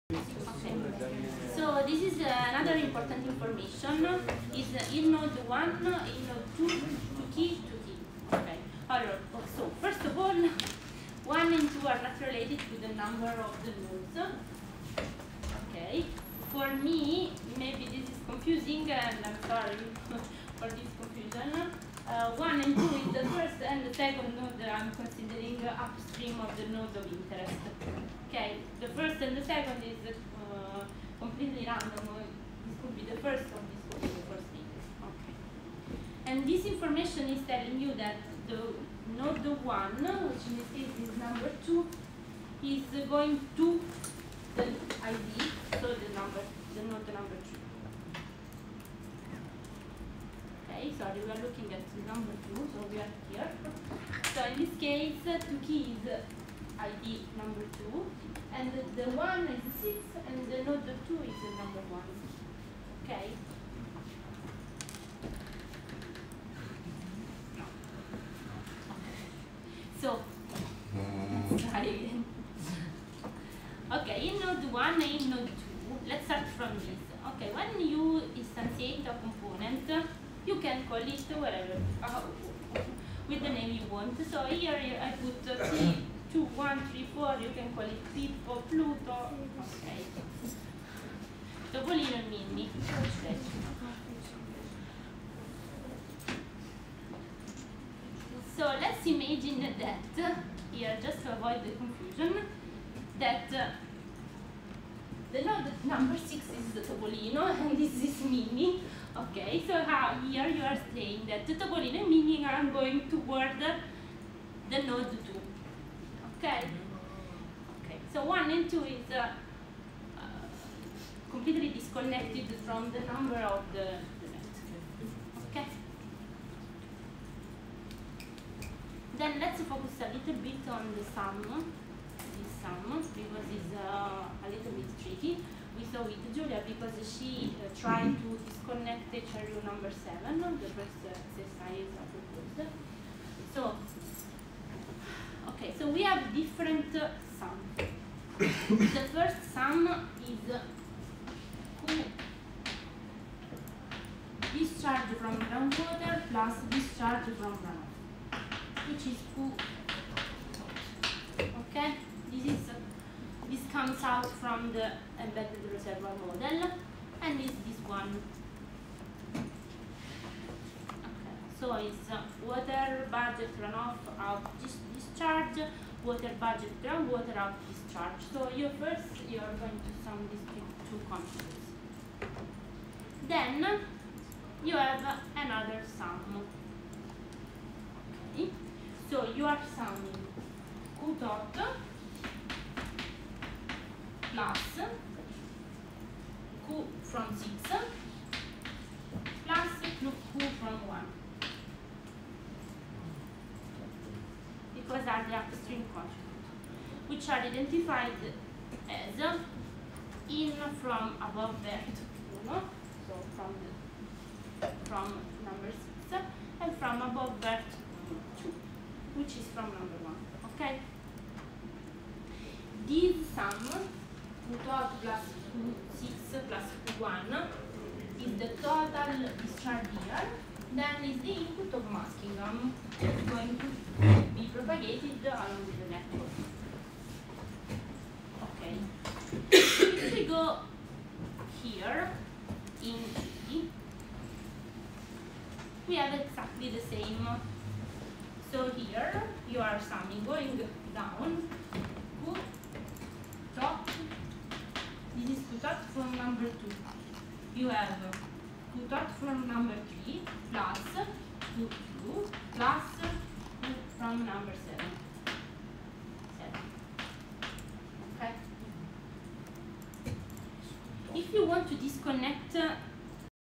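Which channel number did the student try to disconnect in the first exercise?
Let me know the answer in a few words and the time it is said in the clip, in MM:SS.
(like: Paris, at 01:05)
7, at 02:19.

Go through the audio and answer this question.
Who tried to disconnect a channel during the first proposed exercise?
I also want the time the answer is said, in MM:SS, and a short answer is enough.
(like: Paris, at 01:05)
Julia, at 02:16.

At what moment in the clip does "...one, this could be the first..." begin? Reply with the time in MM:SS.
00:33.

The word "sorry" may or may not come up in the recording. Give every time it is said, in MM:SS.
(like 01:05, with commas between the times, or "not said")
00:19, 00:50, 01:11.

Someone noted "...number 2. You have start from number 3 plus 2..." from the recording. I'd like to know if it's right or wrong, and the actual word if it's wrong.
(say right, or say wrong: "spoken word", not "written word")
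right.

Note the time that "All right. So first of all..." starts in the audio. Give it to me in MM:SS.
00:08.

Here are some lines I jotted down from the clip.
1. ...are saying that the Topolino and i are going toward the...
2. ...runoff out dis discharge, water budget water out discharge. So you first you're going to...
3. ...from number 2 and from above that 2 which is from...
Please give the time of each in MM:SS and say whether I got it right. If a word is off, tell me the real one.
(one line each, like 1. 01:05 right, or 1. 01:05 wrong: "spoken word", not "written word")
1. 01:50 right
2. 02:53 wrong: "groundwater", not "water"
3. 03:34 wrong: "6", not "2".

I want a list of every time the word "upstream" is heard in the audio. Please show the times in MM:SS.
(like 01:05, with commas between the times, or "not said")
00:25, 03:25.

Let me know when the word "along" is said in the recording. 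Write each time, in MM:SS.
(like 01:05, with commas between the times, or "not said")
03:55.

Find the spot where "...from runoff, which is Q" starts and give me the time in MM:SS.
02:37.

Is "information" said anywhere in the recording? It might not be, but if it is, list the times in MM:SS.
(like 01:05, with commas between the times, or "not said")
00:03, 00:36.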